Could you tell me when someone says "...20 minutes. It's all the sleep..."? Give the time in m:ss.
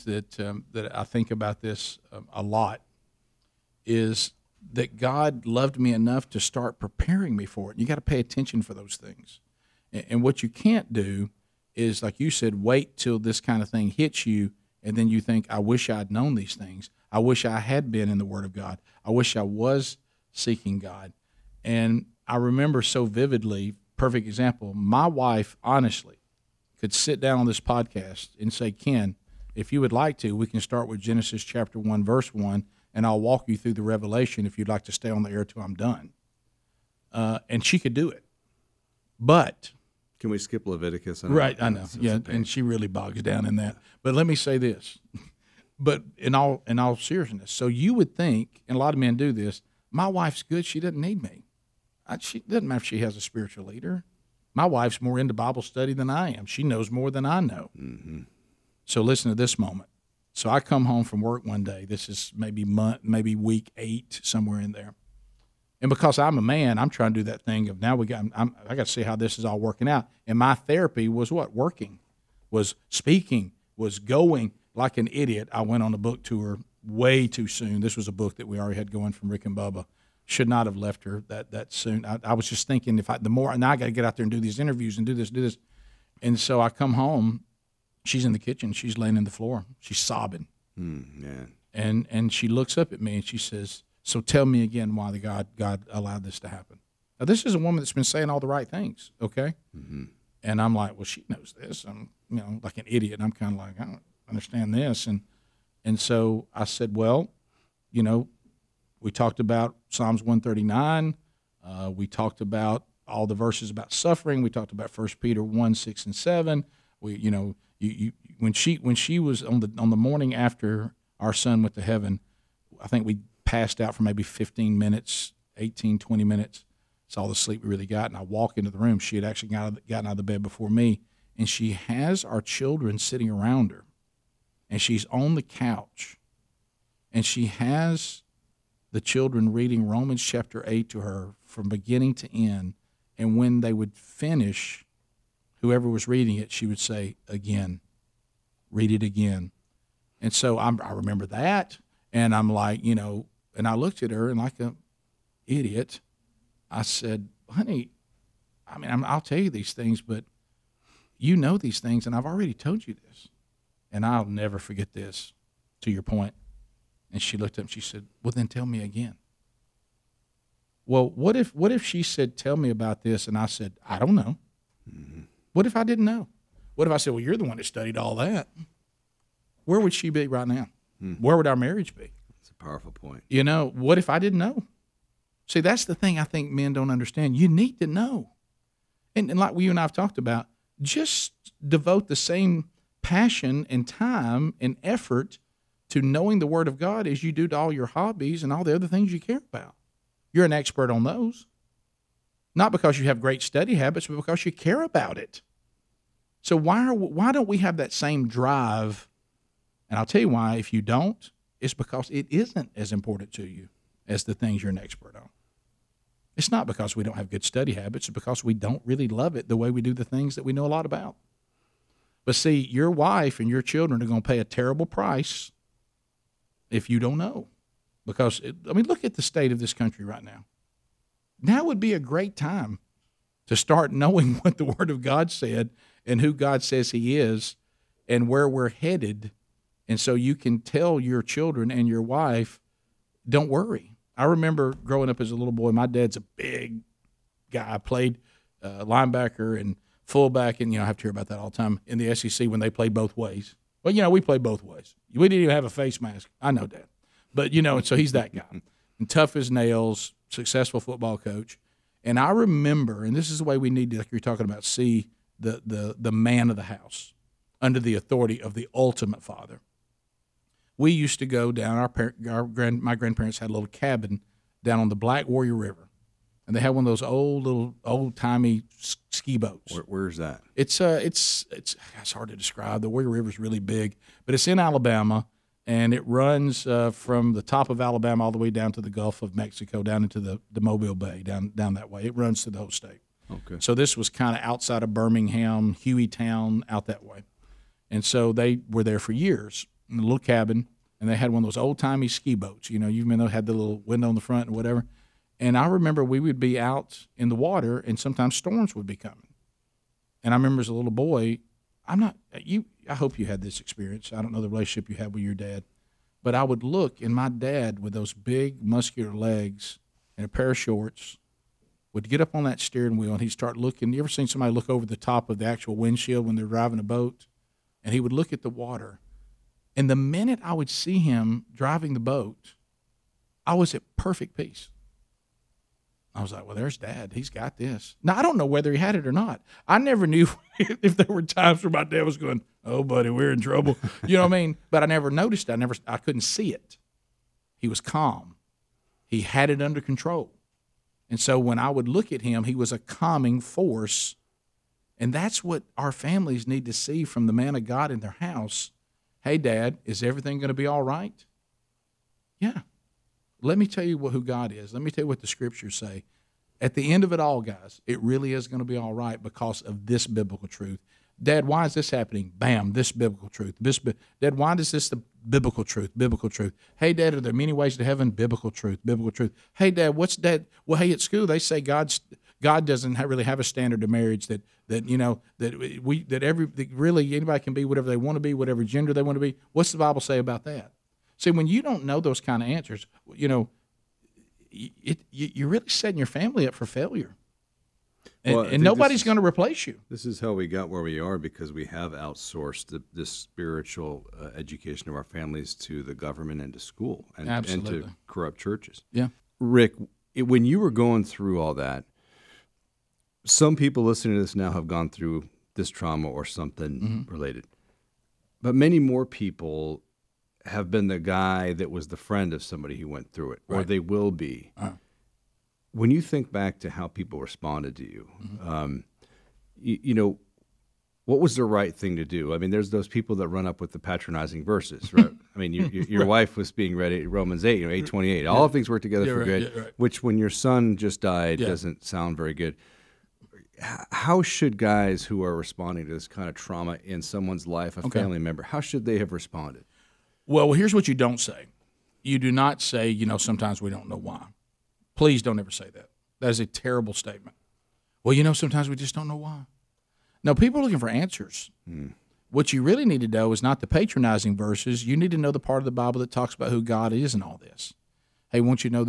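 2:05.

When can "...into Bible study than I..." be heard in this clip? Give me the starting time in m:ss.
0:55.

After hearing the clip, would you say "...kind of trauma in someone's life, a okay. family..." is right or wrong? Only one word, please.
right.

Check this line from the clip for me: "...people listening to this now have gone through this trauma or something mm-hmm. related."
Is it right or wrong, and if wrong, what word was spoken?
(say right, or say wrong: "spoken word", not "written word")
right.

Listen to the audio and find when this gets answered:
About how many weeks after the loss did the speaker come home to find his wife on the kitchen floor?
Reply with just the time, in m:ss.
1:03.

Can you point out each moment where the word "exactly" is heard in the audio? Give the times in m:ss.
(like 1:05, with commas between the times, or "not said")
not said.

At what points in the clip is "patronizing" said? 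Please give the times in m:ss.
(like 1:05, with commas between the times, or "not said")
7:13, 7:43.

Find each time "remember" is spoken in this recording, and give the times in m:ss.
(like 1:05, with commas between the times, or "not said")
0:22, 2:30, 4:04, 4:22, 5:05, 5:10.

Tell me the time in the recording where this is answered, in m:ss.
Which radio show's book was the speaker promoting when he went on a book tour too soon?
1:19.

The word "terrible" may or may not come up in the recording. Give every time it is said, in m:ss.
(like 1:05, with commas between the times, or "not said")
3:44, 7:36.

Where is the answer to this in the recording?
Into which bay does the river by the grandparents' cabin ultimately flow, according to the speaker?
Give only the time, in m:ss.
4:50.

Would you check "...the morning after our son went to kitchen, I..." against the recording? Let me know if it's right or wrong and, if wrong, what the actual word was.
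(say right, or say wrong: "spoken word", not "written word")
wrong: "heaven", not "kitchen".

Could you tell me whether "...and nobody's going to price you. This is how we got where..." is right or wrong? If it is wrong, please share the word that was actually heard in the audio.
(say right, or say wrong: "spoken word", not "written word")
wrong: "replace", not "price".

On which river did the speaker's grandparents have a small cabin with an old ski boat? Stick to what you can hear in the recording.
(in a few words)
Black Warrior River.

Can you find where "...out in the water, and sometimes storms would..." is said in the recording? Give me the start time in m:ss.
5:06.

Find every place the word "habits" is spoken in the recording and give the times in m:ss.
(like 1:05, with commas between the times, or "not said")
3:23, 3:37.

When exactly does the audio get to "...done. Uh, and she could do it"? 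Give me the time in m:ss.
0:35.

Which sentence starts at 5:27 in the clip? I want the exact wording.
And he would look at the water.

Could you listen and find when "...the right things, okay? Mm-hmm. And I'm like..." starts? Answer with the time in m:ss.
1:38.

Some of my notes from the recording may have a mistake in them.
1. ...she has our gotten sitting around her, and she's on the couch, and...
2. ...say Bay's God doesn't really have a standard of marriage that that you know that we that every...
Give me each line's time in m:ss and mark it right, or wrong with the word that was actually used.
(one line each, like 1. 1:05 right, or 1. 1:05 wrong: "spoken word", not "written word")
1. 2:11 wrong: "children", not "gotten"
2. 6:21 wrong: "God", not "Bay".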